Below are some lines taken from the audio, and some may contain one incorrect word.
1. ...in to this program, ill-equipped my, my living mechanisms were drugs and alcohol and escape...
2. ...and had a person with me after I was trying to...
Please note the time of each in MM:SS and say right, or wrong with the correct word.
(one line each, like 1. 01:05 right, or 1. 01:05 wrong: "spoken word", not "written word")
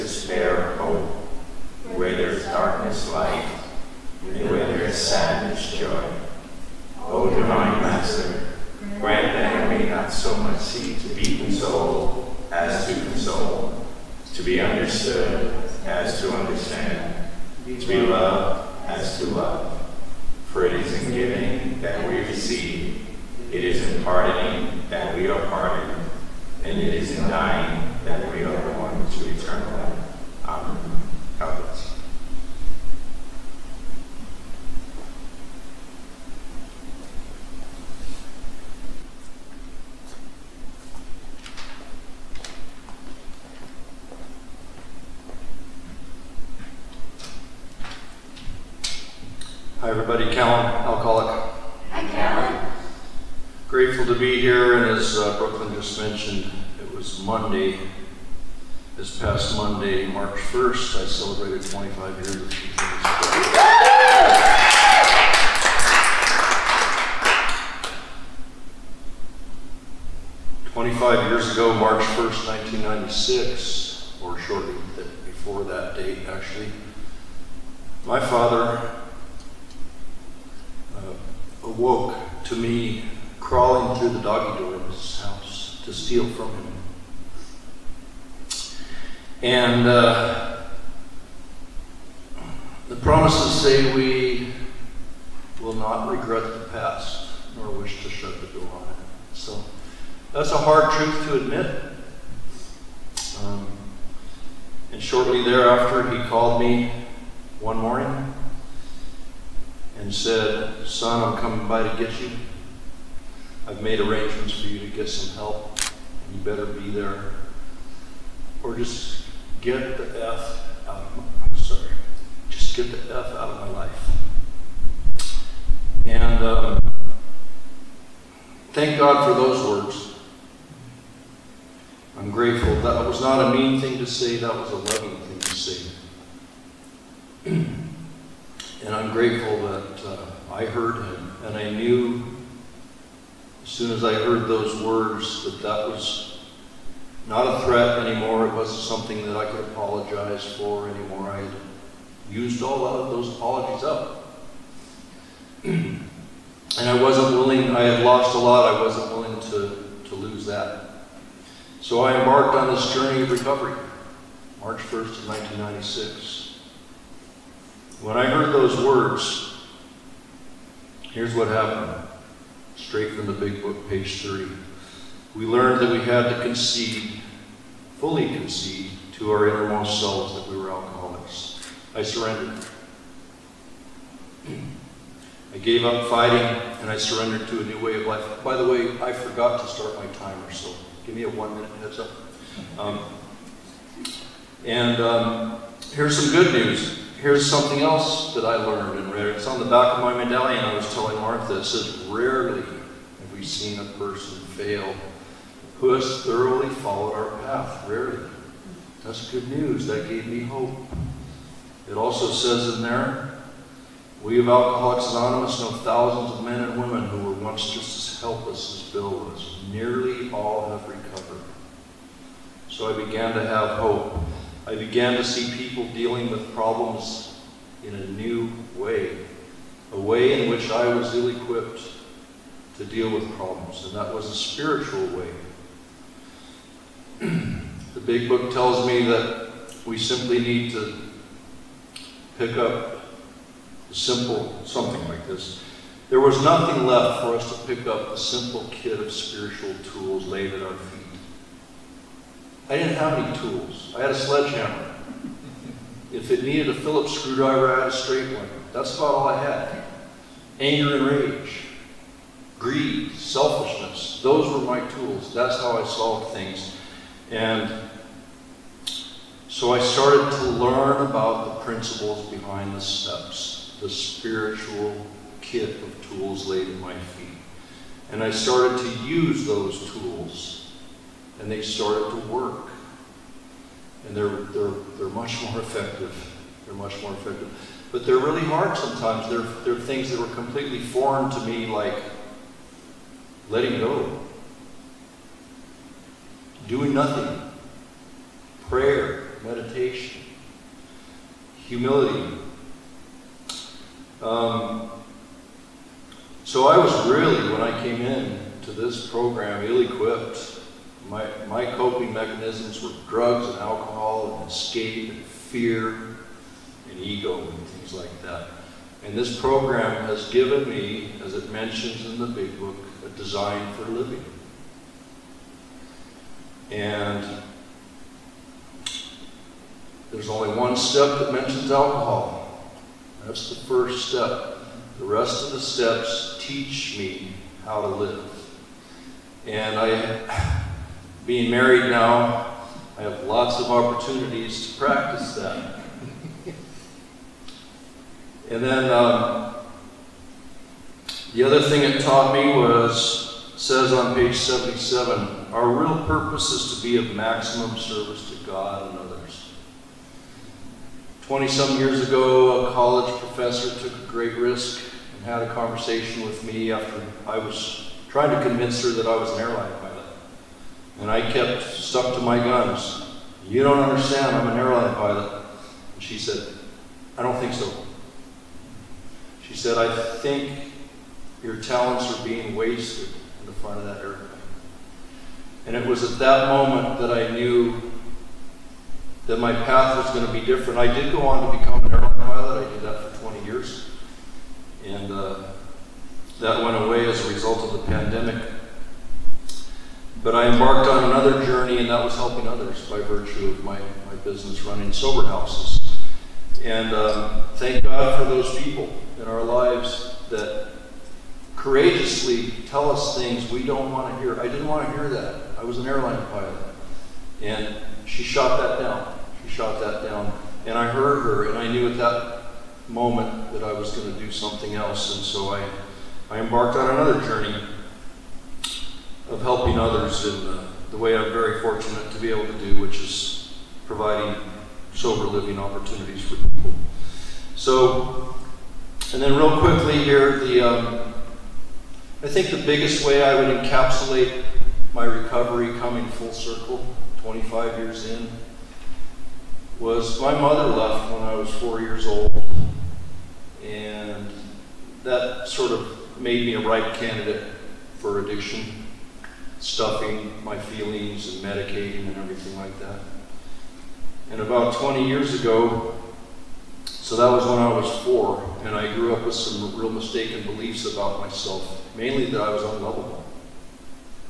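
1. 05:08 wrong: "coping", not "living"
2. 06:05 wrong: "conversation", not "person".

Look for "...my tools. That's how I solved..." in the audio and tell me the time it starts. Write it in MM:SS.
04:24.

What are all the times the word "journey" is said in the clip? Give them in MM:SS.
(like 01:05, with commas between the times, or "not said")
02:42, 06:41, 07:07.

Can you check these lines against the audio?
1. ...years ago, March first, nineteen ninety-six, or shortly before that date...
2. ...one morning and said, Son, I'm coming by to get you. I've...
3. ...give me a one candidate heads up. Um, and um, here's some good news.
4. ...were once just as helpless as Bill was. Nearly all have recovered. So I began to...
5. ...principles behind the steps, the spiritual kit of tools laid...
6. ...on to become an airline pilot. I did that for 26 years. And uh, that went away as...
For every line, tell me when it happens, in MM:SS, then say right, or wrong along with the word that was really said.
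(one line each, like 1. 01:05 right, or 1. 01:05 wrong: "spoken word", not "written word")
1. 01:11 right
2. 01:47 right
3. 03:11 wrong: "minute", not "candidate"
4. 03:37 right
5. 04:31 right
6. 06:31 wrong: "20", not "26".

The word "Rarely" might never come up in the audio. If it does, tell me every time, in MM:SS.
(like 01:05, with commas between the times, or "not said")
03:22, 03:27.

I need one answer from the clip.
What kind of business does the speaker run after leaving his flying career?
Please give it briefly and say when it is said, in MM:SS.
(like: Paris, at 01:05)
sober houses, at 06:44.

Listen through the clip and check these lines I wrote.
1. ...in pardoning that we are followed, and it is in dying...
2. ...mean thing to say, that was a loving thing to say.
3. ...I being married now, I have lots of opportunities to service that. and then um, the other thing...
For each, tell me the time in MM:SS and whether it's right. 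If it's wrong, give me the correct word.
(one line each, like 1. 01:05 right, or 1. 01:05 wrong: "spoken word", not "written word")
1. 00:23 wrong: "pardoned", not "followed"
2. 02:13 right
3. 05:39 wrong: "practice", not "service".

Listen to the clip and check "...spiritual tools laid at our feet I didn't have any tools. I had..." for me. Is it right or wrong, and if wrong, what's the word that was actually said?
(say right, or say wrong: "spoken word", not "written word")
right.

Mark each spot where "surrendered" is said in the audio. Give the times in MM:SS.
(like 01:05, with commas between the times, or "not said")
03:02, 03:06.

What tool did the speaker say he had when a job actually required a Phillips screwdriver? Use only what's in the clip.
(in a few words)
a straight one.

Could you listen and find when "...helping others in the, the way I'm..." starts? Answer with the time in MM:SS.
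07:09.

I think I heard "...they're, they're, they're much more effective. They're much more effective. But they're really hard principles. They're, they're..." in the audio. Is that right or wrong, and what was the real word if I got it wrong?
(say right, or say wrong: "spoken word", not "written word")
wrong: "sometimes", not "principles".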